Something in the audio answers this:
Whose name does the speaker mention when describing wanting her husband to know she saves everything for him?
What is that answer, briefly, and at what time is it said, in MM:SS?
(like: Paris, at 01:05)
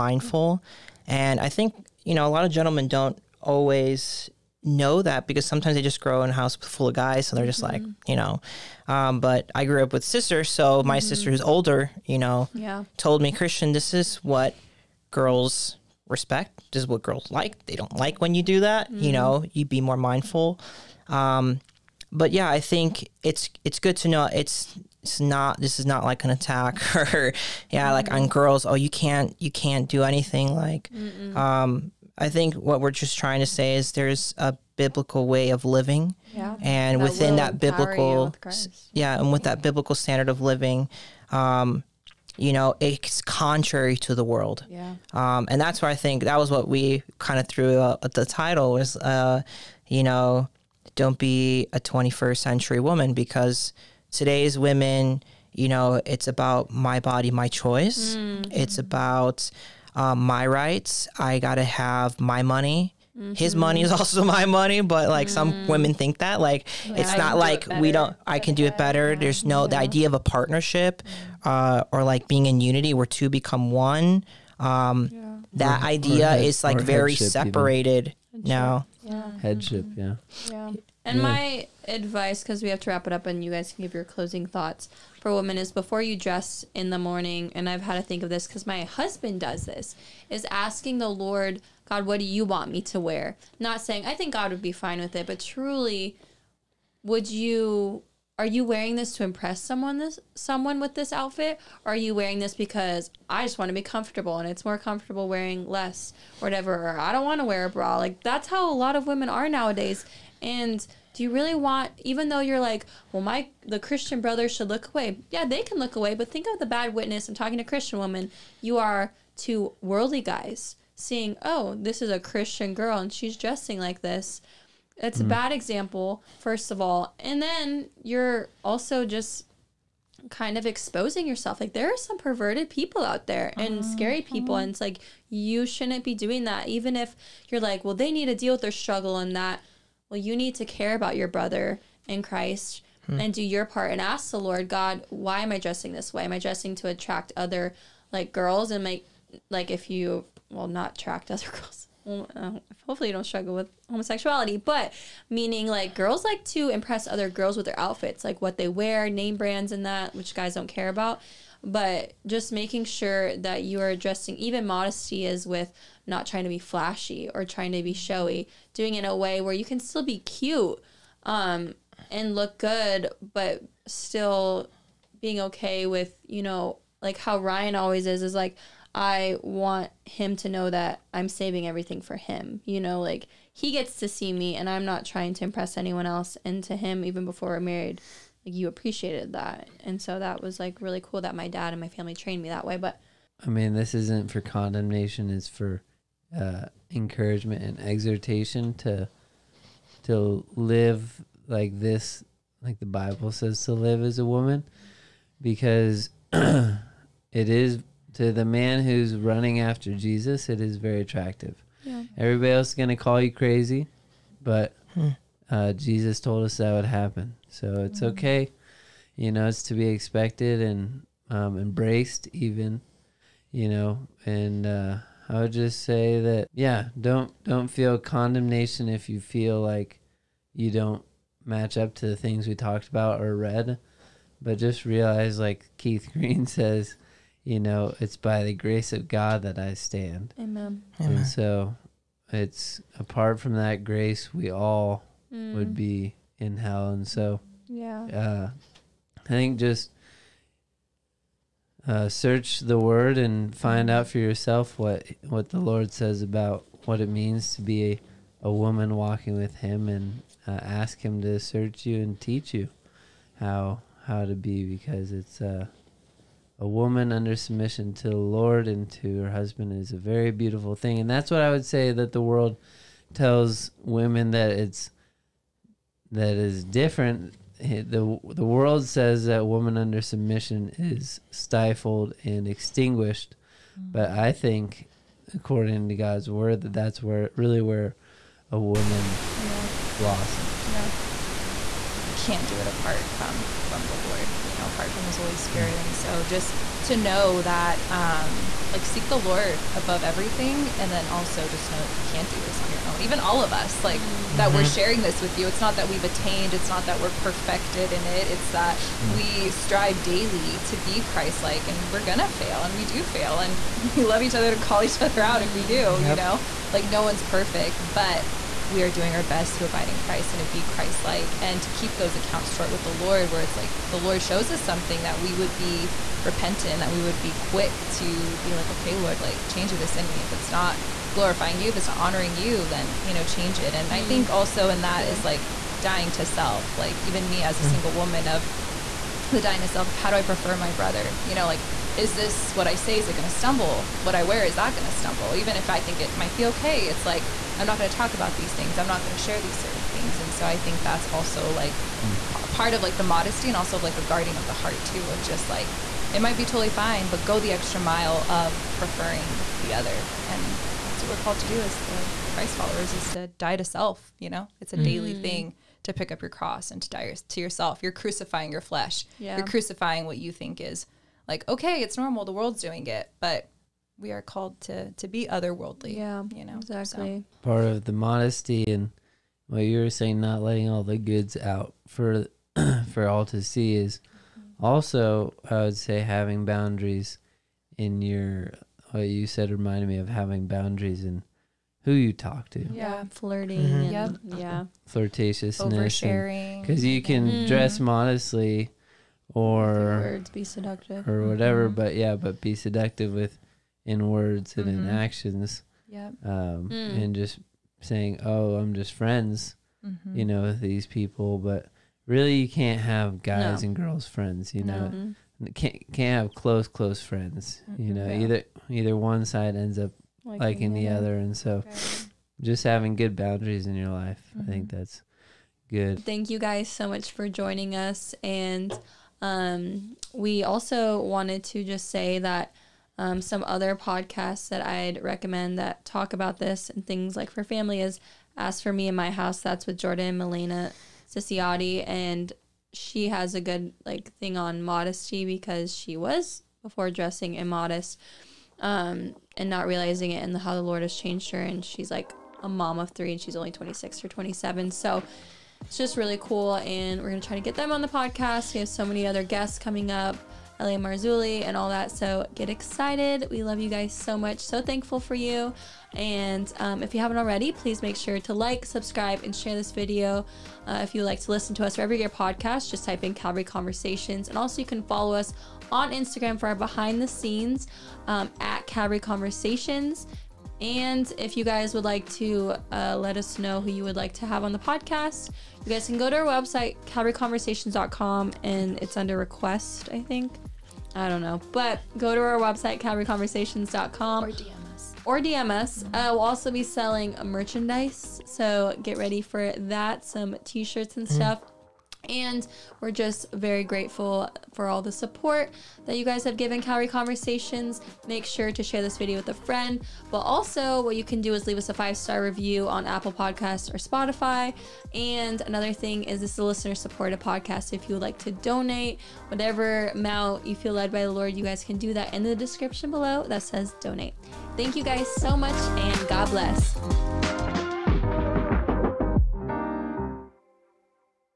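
Ryan, at 02:57.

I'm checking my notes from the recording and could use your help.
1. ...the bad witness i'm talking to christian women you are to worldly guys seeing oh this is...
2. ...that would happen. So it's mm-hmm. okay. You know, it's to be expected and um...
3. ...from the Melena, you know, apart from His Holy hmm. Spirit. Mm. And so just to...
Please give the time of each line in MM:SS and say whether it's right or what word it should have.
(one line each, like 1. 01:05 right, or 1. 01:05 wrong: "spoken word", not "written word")
1. 01:56 right
2. 03:36 right
3. 04:53 wrong: "Lord", not "Melena".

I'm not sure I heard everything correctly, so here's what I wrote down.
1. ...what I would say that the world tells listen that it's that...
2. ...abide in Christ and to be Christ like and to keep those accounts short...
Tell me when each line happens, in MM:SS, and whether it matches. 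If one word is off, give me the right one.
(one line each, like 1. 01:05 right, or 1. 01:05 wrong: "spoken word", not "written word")
1. 04:31 wrong: "women", not "listen"
2. 05:19 right.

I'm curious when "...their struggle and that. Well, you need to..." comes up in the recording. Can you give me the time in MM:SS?
02:18.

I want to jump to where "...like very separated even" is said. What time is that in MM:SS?
01:16.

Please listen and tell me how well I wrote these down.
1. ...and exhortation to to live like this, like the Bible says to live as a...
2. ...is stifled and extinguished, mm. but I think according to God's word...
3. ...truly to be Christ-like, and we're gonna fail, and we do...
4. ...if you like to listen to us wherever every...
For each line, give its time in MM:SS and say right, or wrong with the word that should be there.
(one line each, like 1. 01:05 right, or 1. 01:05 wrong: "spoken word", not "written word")
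1. 03:17 right
2. 04:40 right
3. 05:10 wrong: "daily", not "truly"
4. 07:50 right.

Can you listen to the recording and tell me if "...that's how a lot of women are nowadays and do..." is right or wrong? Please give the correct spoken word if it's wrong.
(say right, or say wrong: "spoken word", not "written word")
right.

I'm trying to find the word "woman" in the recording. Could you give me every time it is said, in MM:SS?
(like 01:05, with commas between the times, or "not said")
00:52, 03:24, 04:18, 04:26, 04:39, 04:48, 05:37.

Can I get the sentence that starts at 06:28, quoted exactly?
What you said reminded me of having boundaries in who you talk to.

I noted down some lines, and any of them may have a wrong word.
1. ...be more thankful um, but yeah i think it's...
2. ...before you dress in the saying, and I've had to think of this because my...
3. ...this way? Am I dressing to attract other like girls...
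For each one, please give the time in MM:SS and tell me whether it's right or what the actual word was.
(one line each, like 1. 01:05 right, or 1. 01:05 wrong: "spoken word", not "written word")
1. 00:19 wrong: "mindful", not "thankful"
2. 01:25 wrong: "morning", not "saying"
3. 02:25 right.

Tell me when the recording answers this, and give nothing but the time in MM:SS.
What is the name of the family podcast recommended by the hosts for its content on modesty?
07:18.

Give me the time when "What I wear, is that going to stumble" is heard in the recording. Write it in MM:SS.
05:44.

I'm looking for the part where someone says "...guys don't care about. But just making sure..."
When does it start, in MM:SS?
02:40.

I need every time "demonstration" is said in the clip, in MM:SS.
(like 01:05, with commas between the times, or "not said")
not said.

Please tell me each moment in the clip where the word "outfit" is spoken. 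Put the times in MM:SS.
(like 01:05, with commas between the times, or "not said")
01:41, 02:37.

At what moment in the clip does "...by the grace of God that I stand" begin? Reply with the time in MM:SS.
03:58.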